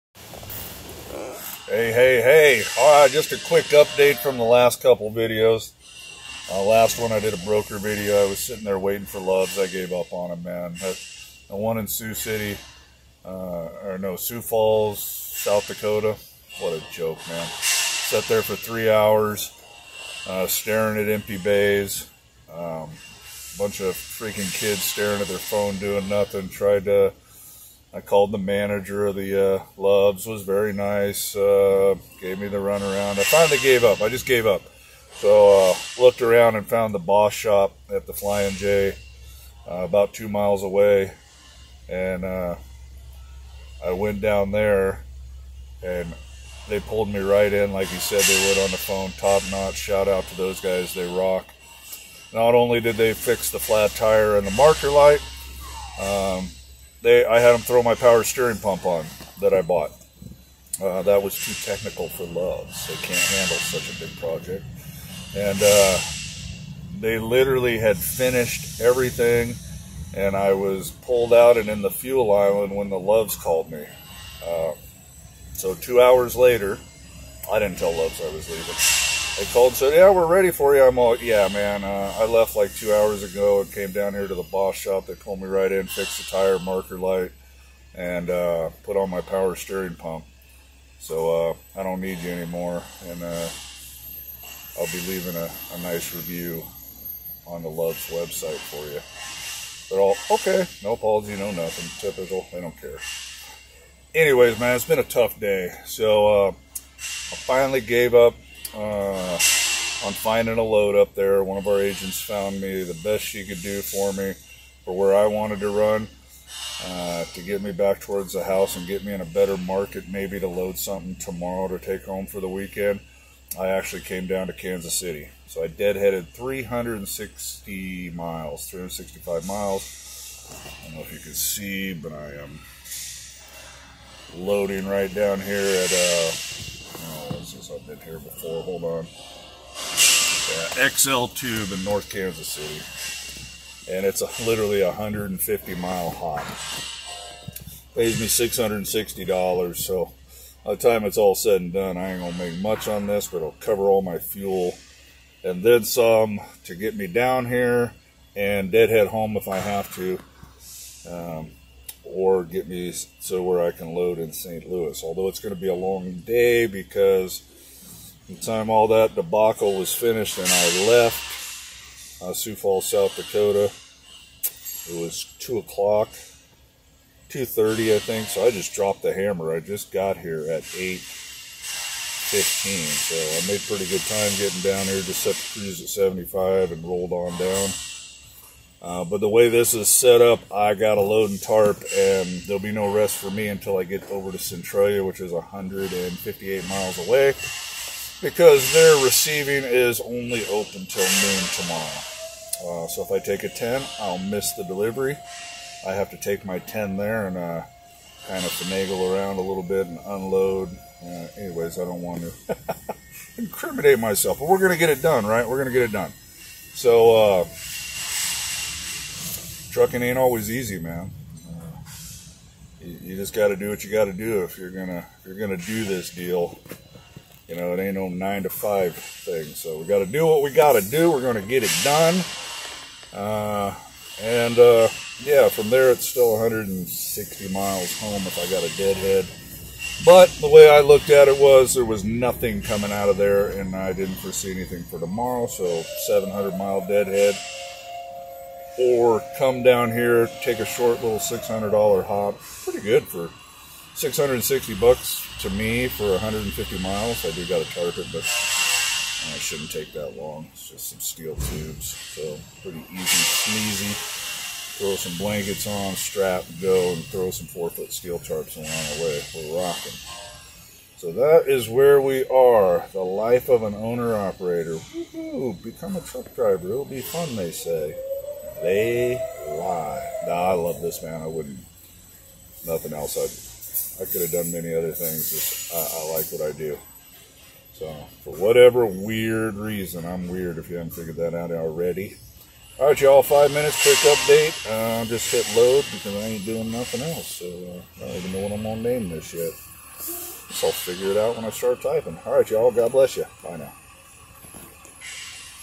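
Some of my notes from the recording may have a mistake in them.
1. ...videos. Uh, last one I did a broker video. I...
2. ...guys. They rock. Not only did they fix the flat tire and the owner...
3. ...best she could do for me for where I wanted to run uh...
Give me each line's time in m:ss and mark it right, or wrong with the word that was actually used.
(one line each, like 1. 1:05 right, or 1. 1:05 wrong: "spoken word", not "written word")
1. 0:05 right
2. 0:50 wrong: "marker", not "owner"
3. 1:53 right.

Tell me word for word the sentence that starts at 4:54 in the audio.
Uh, just hit load because I ain't doing nothing else.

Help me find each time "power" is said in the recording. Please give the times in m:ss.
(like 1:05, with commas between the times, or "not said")
0:57, 1:29.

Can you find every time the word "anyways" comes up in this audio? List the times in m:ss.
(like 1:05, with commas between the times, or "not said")
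1:44, 3:31.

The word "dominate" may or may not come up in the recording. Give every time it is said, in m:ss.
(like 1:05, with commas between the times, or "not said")
not said.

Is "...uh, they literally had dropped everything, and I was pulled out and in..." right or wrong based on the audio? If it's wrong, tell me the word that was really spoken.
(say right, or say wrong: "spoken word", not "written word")
wrong: "finished", not "dropped".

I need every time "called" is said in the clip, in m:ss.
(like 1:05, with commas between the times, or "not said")
0:27, 1:13, 1:19.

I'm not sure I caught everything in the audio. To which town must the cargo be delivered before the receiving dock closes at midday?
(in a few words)
Centralia.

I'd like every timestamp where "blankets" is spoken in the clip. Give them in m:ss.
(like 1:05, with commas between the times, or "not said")
4:25.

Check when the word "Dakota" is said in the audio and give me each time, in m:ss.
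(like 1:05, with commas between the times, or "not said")
0:15, 2:53.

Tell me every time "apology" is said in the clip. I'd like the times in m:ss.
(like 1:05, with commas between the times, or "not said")
1:40.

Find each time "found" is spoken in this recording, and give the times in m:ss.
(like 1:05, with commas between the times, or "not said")
0:36, 1:52.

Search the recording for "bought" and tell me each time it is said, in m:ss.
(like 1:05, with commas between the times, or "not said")
0:59.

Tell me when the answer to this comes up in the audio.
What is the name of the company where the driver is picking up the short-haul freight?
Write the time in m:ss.
2:20.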